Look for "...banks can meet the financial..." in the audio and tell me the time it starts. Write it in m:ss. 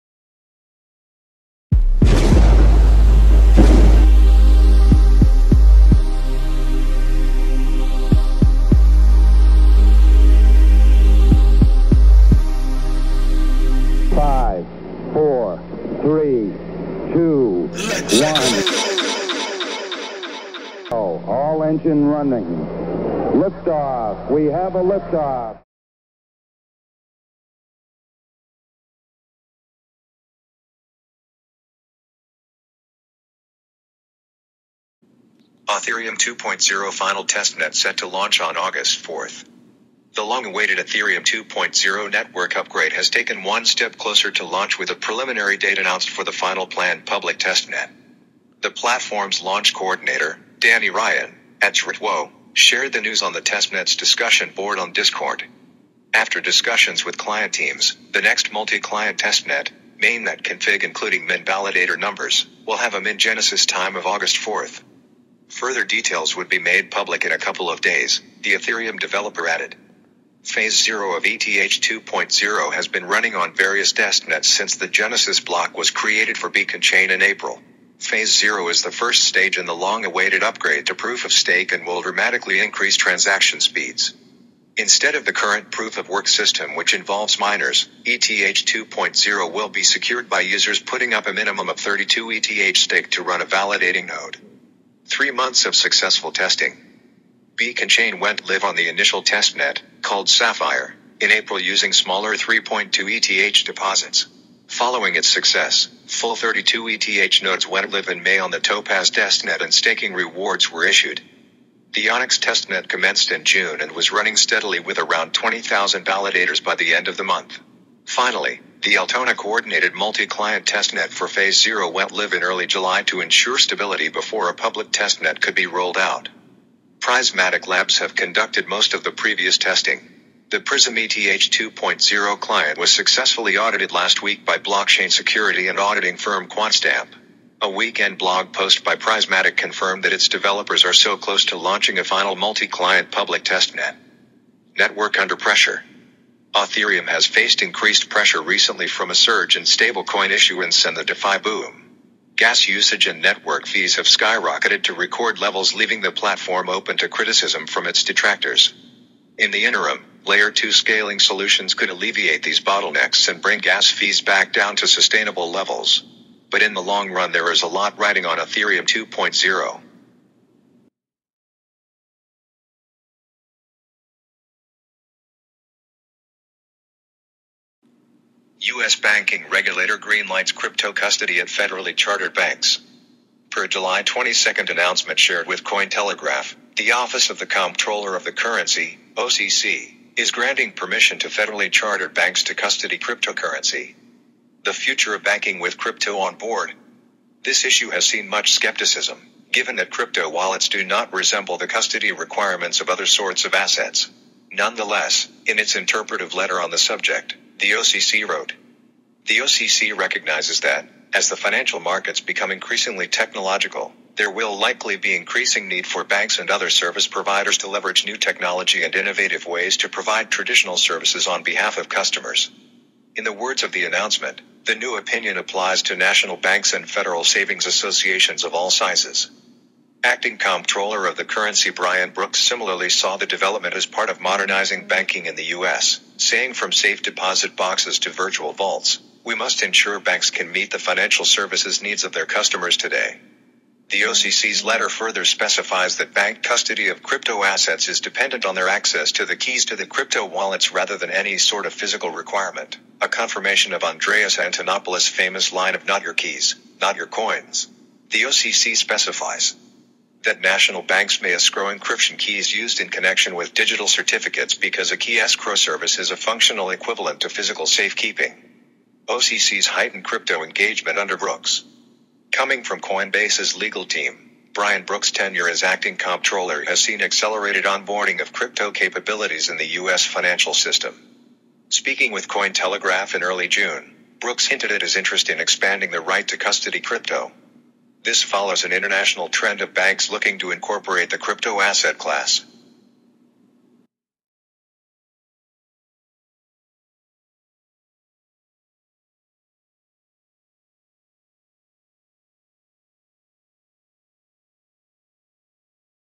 3:59.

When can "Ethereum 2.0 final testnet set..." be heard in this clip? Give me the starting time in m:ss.
0:35.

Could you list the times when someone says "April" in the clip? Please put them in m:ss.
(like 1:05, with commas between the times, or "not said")
1:17, 1:41.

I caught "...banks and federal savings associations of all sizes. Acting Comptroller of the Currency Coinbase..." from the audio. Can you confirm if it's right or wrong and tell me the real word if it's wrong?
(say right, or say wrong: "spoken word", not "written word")
wrong: "Brian", not "Coinbase".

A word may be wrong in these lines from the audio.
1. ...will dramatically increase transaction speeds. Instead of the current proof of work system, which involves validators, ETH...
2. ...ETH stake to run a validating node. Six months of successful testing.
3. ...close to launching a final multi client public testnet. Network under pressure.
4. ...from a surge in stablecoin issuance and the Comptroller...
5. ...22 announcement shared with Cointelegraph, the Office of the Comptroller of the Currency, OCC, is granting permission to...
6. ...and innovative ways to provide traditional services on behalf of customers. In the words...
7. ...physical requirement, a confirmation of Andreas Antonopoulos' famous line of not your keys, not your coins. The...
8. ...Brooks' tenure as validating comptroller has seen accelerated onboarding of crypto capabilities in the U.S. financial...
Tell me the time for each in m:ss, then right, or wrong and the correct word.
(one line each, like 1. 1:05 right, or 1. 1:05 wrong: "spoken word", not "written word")
1. 1:21 wrong: "miners", not "validators"
2. 1:32 wrong: "Three", not "Six"
3. 2:21 right
4. 2:28 wrong: "DeFi", not "Comptroller"
5. 3:04 right
6. 3:38 right
7. 4:11 right
8. 4:34 wrong: "acting", not "validating".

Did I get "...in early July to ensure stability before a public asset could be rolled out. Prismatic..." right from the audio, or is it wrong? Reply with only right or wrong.
wrong.